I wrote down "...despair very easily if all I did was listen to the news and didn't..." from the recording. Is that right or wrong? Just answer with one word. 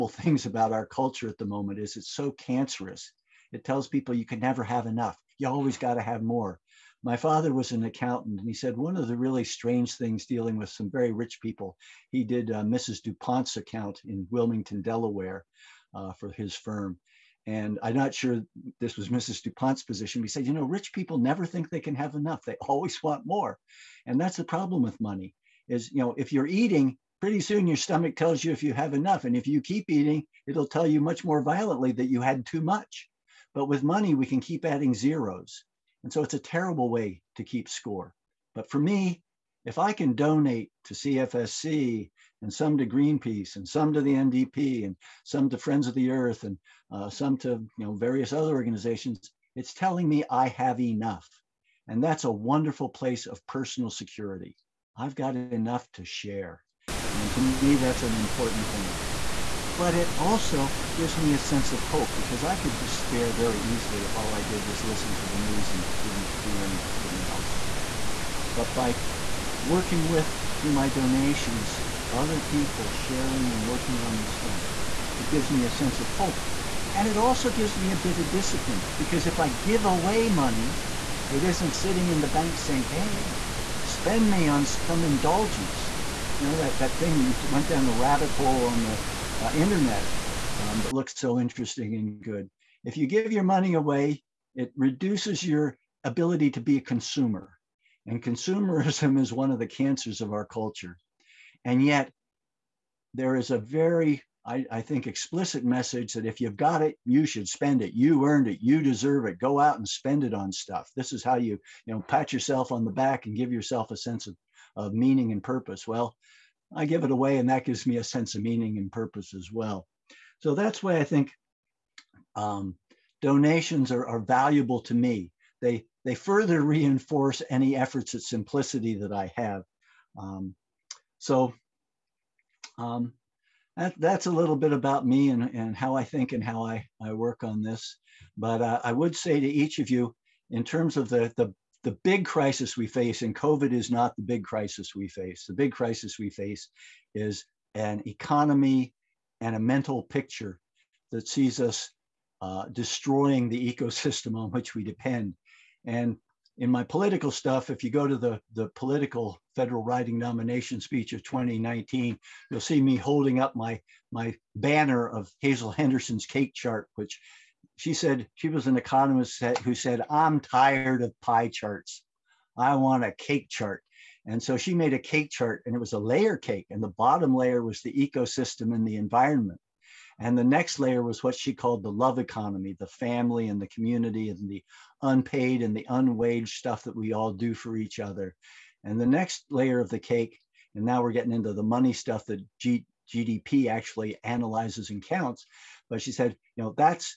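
right.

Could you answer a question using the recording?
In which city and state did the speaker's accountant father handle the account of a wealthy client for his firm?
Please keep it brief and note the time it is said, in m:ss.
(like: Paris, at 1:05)
Wilmington, Delaware, at 0:14.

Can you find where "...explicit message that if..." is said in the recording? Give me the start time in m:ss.
1:45.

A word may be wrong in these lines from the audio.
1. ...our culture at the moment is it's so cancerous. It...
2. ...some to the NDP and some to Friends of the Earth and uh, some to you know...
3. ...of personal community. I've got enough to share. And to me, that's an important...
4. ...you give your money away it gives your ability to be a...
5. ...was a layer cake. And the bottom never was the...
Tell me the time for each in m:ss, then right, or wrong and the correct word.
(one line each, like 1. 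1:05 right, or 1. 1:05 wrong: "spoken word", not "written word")
1. 0:00 right
2. 0:43 right
3. 0:53 wrong: "security", not "community"
4. 1:32 wrong: "reduces", not "gives"
5. 2:55 wrong: "layer", not "never".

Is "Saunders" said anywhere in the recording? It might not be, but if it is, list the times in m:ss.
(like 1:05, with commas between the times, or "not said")
not said.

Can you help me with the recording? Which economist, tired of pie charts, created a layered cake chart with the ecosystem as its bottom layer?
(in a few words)
Hazel Henderson.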